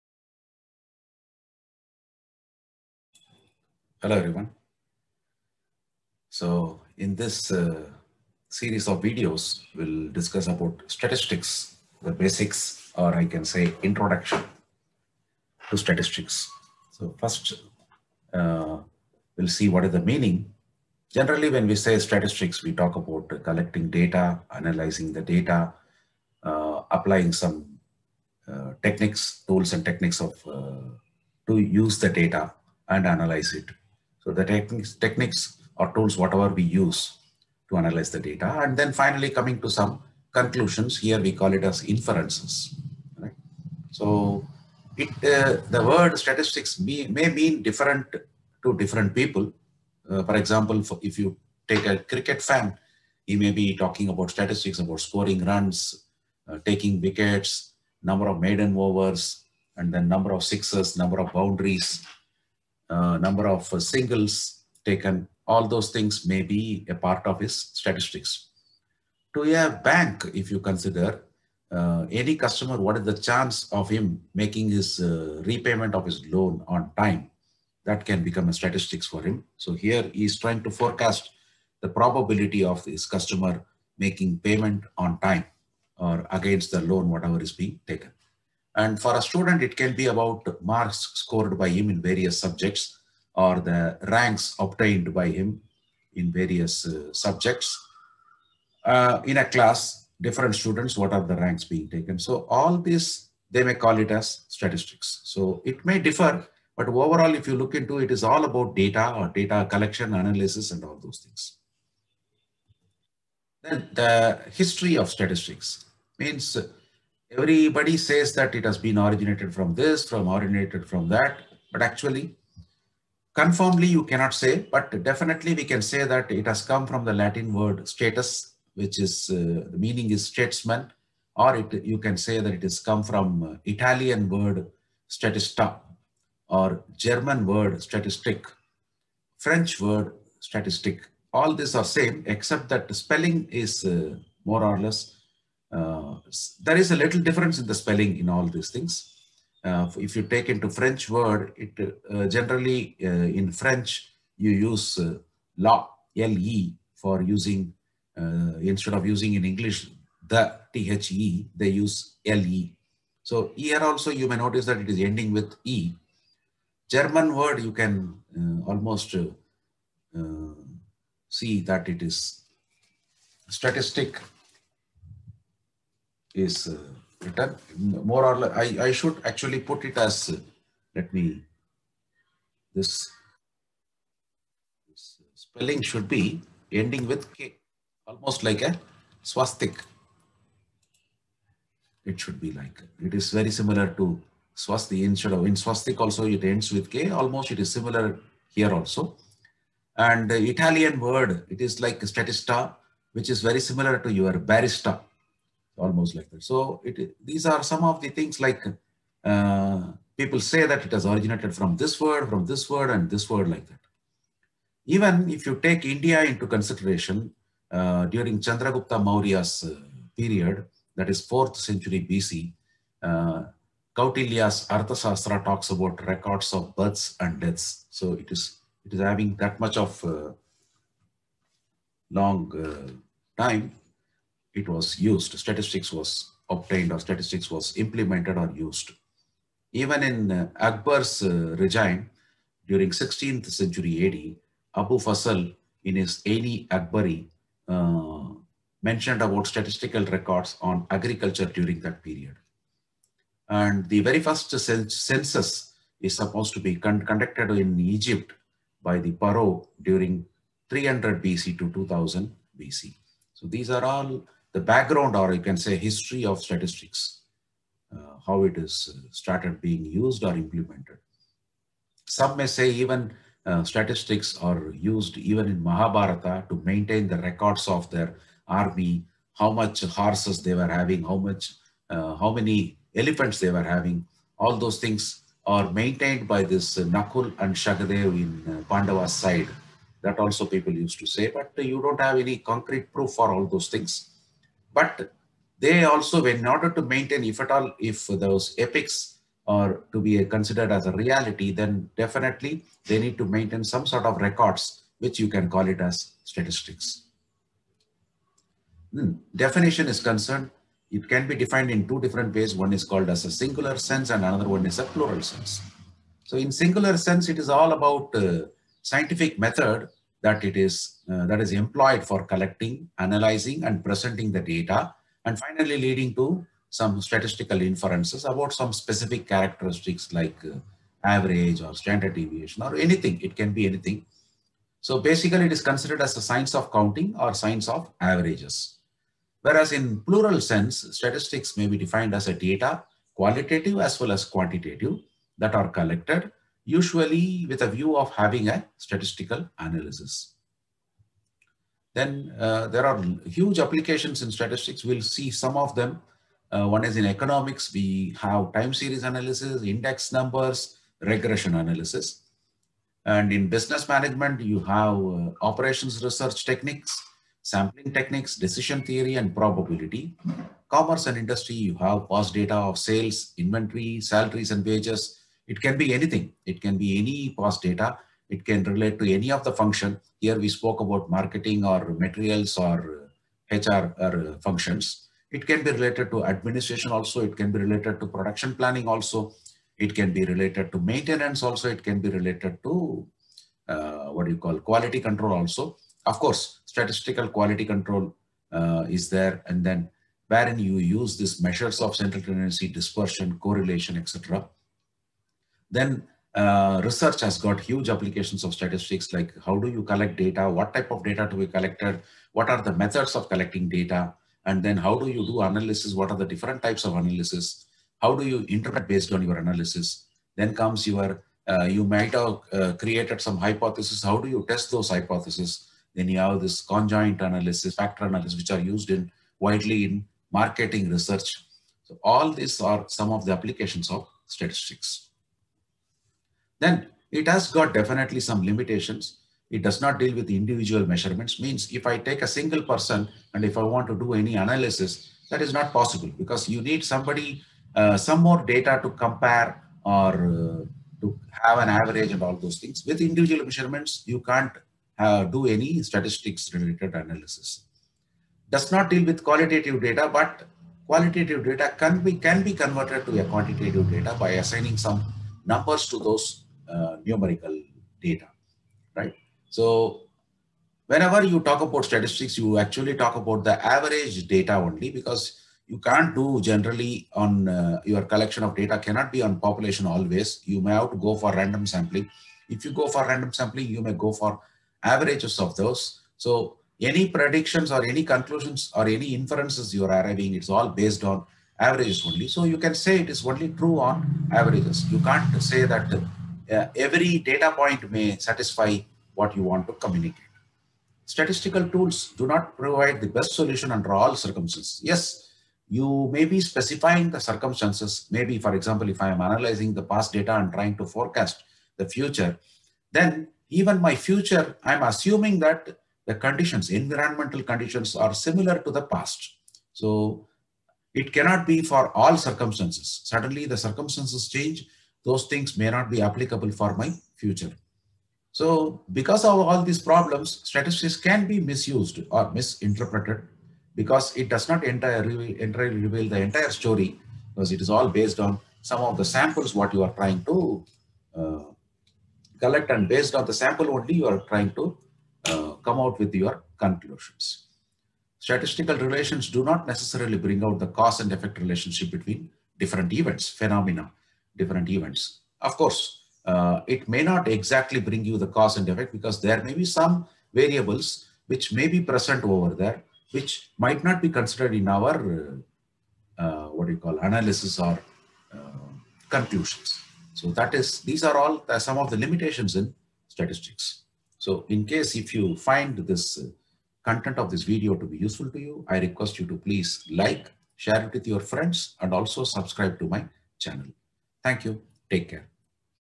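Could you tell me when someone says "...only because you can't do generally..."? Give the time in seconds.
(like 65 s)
474 s.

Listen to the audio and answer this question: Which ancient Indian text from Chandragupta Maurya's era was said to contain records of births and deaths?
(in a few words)
Arthasastra.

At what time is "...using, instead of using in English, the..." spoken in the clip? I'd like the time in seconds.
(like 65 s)
157 s.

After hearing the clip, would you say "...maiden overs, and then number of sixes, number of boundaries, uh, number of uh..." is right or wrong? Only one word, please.
right.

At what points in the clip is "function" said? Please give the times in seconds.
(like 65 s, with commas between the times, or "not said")
379 s, 384 s.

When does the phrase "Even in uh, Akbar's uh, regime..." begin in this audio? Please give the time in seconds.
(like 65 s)
239 s.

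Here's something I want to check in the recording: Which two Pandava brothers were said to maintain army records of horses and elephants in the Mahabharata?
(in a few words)
Nakul and Sahadev.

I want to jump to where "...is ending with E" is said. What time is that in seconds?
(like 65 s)
164 s.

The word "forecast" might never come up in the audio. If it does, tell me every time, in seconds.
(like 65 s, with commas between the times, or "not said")
80 s, 510 s.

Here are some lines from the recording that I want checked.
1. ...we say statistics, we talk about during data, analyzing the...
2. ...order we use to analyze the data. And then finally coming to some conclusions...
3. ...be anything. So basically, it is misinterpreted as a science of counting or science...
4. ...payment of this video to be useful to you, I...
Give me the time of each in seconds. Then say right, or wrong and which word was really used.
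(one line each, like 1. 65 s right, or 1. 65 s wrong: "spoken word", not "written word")
1. 21 s wrong: "collecting", not "during"
2. 36 s wrong: "whatever", not "order"
3. 333 s wrong: "considered", not "misinterpreted"
4. 576 s wrong: "content", not "payment".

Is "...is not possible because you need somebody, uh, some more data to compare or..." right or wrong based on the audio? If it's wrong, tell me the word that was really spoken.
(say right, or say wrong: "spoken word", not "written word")
right.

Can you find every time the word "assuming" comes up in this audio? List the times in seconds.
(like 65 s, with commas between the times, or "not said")
514 s.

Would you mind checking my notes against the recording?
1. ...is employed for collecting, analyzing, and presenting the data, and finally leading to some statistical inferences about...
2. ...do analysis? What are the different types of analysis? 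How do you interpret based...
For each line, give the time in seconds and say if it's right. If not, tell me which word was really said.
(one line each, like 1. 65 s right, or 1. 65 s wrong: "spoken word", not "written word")
1. 321 s right
2. 415 s right.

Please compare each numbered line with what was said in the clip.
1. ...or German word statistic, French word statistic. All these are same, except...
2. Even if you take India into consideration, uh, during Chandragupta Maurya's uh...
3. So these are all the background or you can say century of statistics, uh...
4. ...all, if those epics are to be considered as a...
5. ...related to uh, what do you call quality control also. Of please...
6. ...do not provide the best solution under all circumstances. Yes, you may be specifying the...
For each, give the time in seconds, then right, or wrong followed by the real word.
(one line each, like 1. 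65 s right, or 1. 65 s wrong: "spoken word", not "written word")
1. 136 s right
2. 214 s right
3. 263 s wrong: "history", not "century"
4. 297 s right
5. 392 s wrong: "course", not "please"
6. 502 s right.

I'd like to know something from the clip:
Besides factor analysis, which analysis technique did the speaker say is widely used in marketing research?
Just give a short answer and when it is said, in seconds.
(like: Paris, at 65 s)
conjoint analysis, at 426 s.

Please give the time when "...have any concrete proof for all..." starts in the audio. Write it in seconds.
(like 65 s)
292 s.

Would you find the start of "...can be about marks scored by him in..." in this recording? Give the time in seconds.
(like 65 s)
89 s.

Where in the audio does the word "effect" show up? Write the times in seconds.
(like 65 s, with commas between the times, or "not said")
551 s, 558 s.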